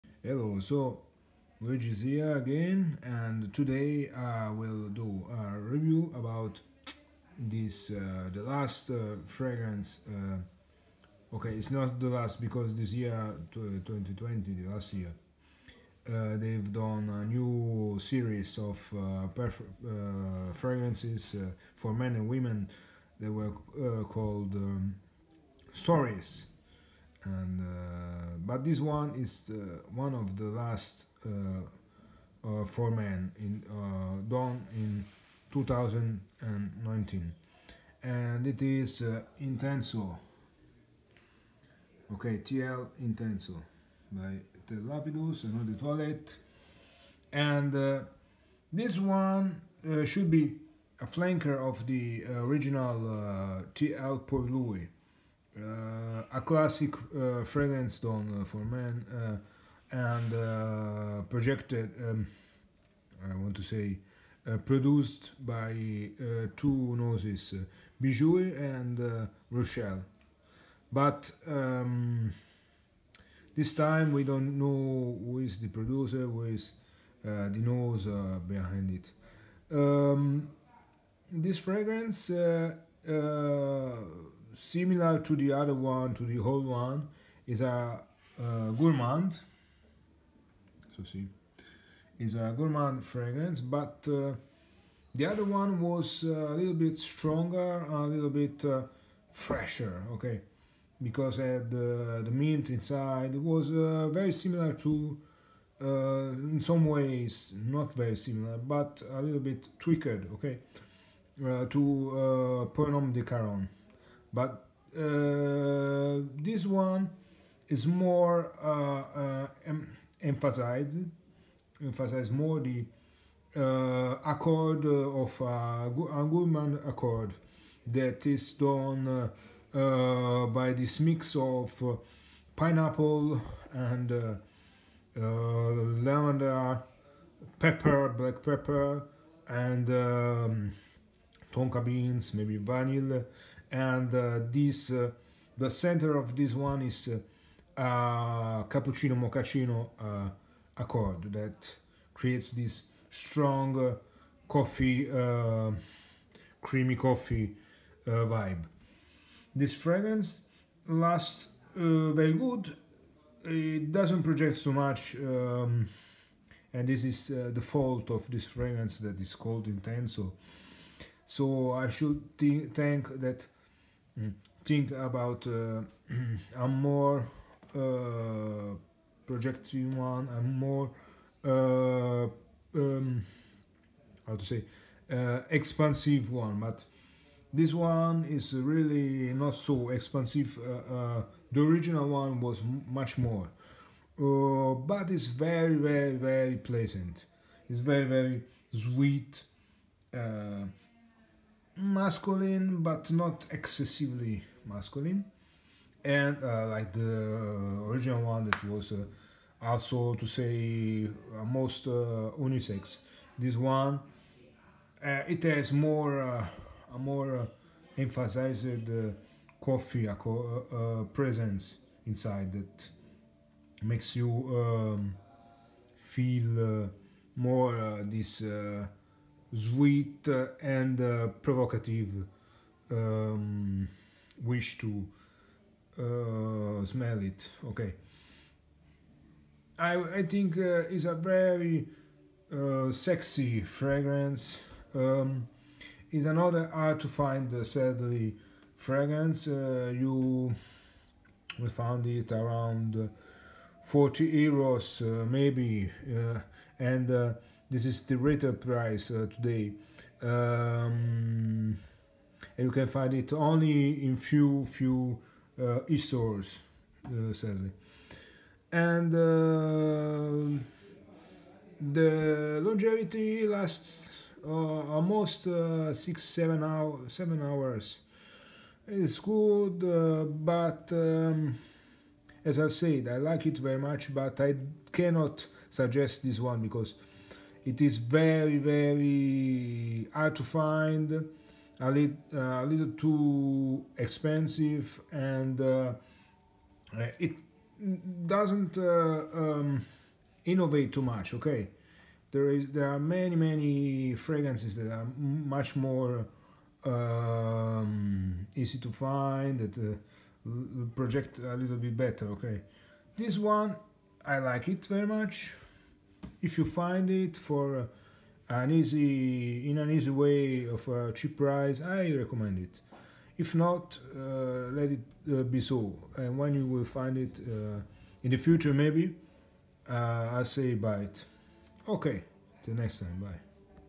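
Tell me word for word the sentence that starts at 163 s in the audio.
It doesn't project too much, um, and this is uh, the fault of this fragrance that is called intenso.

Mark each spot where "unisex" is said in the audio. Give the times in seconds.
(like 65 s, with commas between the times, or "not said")
212 s.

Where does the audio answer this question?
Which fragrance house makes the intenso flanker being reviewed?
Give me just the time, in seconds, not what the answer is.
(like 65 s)
44 s.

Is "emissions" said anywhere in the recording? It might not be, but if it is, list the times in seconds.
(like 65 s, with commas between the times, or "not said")
not said.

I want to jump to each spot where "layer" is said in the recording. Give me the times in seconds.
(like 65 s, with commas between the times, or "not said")
not said.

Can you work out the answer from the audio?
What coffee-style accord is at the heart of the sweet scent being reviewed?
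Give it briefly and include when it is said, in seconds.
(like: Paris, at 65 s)
cappuccino mochaccino accord, at 148 s.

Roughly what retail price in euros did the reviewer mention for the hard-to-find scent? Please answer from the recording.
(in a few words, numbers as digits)
40 euros.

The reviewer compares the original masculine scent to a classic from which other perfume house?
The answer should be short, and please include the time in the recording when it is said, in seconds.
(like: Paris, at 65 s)
Caron, at 113 s.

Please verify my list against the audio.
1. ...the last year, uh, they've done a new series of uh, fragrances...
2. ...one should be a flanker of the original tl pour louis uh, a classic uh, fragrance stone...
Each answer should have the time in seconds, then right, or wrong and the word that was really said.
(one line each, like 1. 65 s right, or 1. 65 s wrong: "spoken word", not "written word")
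1. 14 s right
2. 48 s right.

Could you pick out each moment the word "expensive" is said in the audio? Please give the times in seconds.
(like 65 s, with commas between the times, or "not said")
293 s.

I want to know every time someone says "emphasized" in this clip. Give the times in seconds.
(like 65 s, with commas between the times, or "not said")
120 s, 217 s.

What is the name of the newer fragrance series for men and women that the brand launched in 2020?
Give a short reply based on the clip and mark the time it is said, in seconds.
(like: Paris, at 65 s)
Stories, at 25 s.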